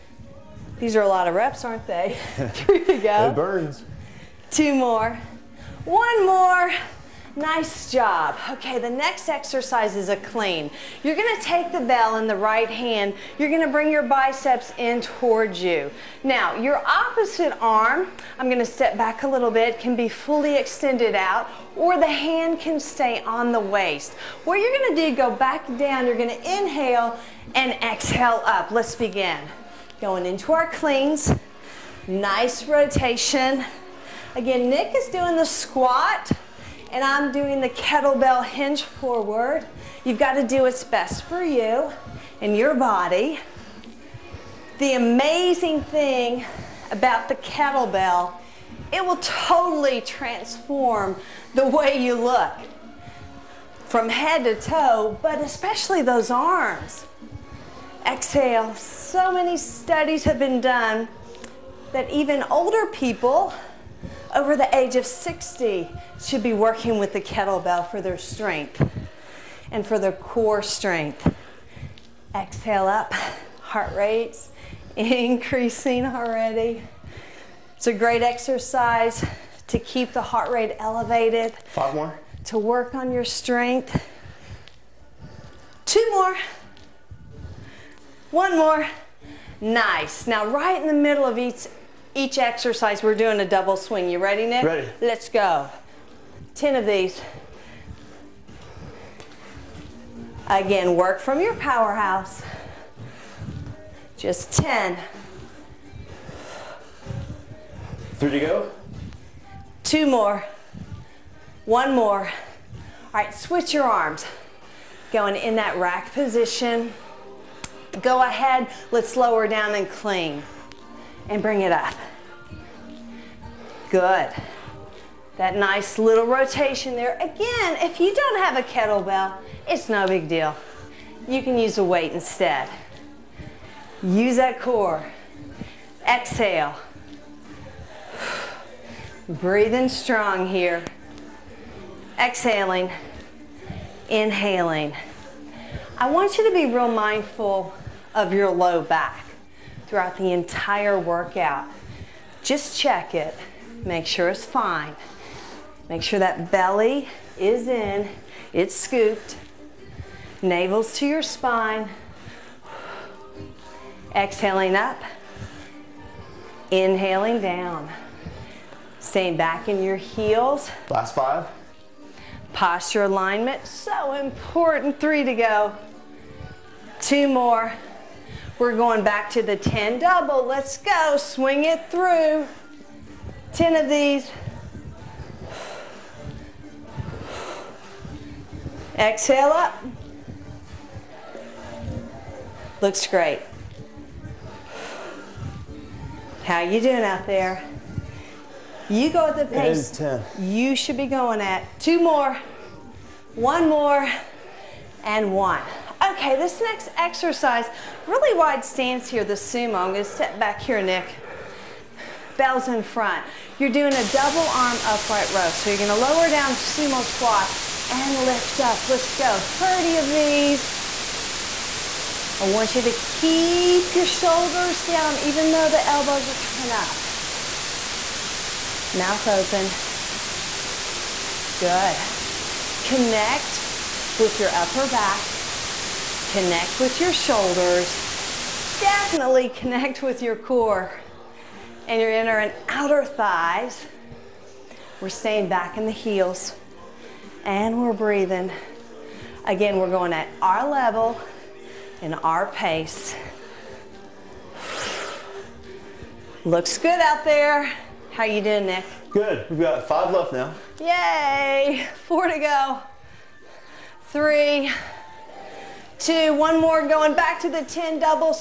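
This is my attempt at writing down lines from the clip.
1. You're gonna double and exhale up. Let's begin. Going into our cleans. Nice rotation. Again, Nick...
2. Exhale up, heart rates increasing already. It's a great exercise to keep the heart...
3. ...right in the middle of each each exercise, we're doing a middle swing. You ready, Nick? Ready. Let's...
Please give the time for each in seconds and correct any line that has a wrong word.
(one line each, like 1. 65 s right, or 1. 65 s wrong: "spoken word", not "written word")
1. 26 s wrong: "inhale", not "double"
2. 72 s right
3. 90 s wrong: "double", not "middle".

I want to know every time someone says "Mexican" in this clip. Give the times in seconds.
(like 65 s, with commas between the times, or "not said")
not said.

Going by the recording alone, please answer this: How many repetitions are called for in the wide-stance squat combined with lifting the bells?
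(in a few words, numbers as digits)
30.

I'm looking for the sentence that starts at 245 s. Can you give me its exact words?
We're staying back in the heels and we're breathing.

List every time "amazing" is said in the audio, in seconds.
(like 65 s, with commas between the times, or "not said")
44 s.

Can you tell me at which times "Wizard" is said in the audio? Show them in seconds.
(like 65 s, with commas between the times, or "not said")
not said.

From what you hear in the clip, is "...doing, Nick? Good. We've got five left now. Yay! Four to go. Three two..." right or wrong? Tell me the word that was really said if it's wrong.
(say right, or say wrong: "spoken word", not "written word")
right.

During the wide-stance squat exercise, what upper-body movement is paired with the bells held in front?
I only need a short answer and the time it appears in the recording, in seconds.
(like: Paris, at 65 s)
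double arm upright row, at 214 s.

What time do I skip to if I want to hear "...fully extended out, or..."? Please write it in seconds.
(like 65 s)
20 s.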